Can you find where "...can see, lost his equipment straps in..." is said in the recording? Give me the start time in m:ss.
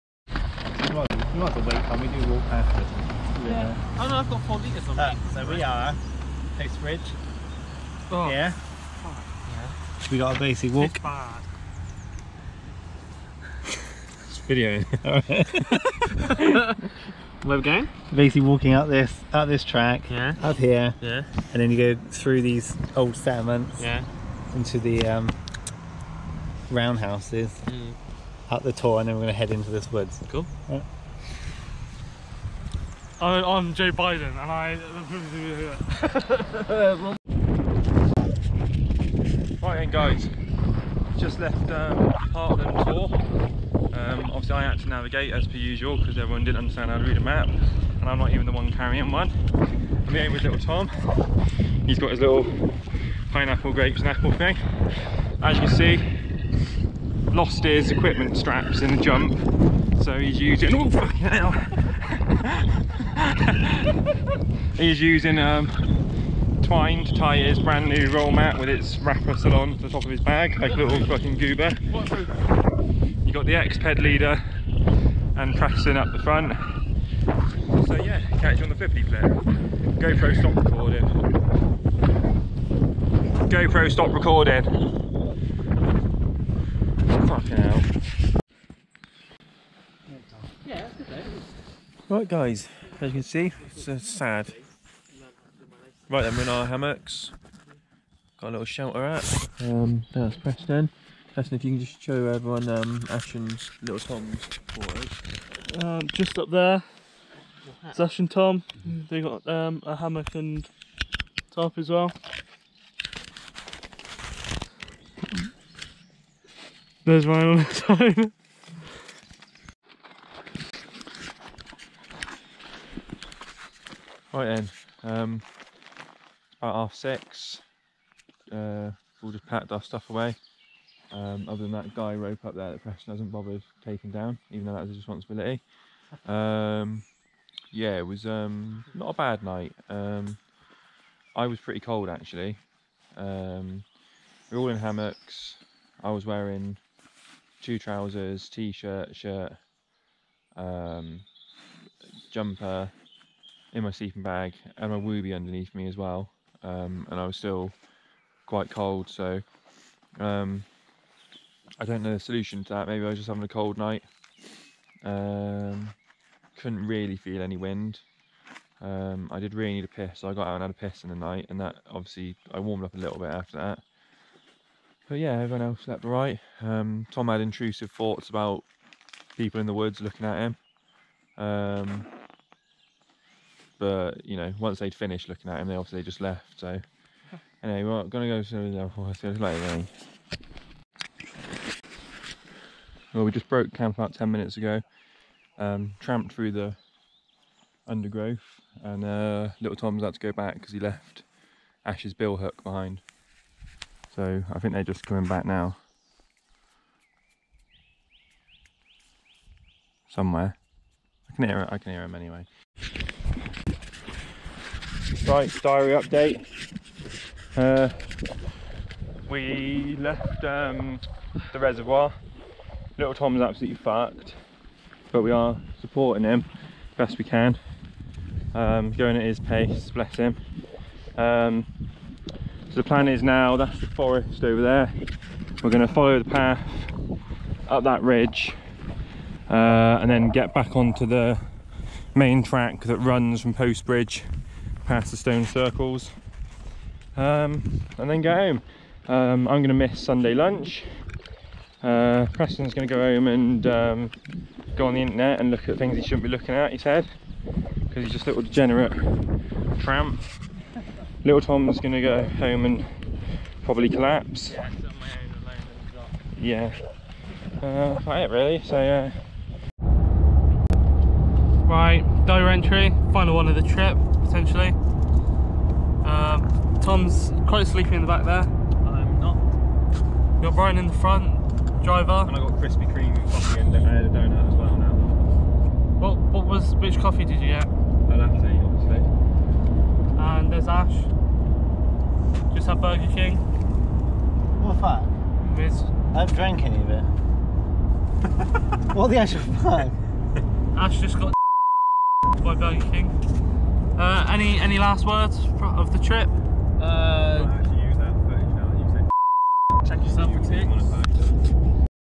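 0:55.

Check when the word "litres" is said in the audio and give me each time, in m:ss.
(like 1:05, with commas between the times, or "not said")
0:04.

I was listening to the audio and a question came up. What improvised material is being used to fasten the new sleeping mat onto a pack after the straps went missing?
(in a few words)
Twine.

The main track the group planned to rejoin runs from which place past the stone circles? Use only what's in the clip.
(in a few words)
Postbridge.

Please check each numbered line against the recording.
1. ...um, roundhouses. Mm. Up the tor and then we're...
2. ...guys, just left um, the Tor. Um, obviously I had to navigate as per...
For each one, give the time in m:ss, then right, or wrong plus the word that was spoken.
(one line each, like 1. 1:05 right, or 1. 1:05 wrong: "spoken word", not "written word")
1. 0:25 right
2. 0:39 right.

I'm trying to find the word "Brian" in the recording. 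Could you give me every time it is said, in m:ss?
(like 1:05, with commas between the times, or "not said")
4:40.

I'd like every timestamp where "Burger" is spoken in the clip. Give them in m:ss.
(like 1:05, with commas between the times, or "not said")
4:52, 5:02.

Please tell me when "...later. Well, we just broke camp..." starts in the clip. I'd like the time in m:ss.
3:09.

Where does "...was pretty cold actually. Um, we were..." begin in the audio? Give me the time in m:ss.
2:21.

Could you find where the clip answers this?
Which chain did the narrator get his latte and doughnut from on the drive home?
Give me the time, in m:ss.
4:42.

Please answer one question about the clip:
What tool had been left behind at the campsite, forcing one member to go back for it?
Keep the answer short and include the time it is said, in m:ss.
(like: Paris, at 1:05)
Billhook, at 3:22.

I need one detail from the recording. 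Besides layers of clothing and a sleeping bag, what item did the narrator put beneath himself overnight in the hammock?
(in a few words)
Wooby.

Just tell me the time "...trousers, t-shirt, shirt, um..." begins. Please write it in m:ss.
2:27.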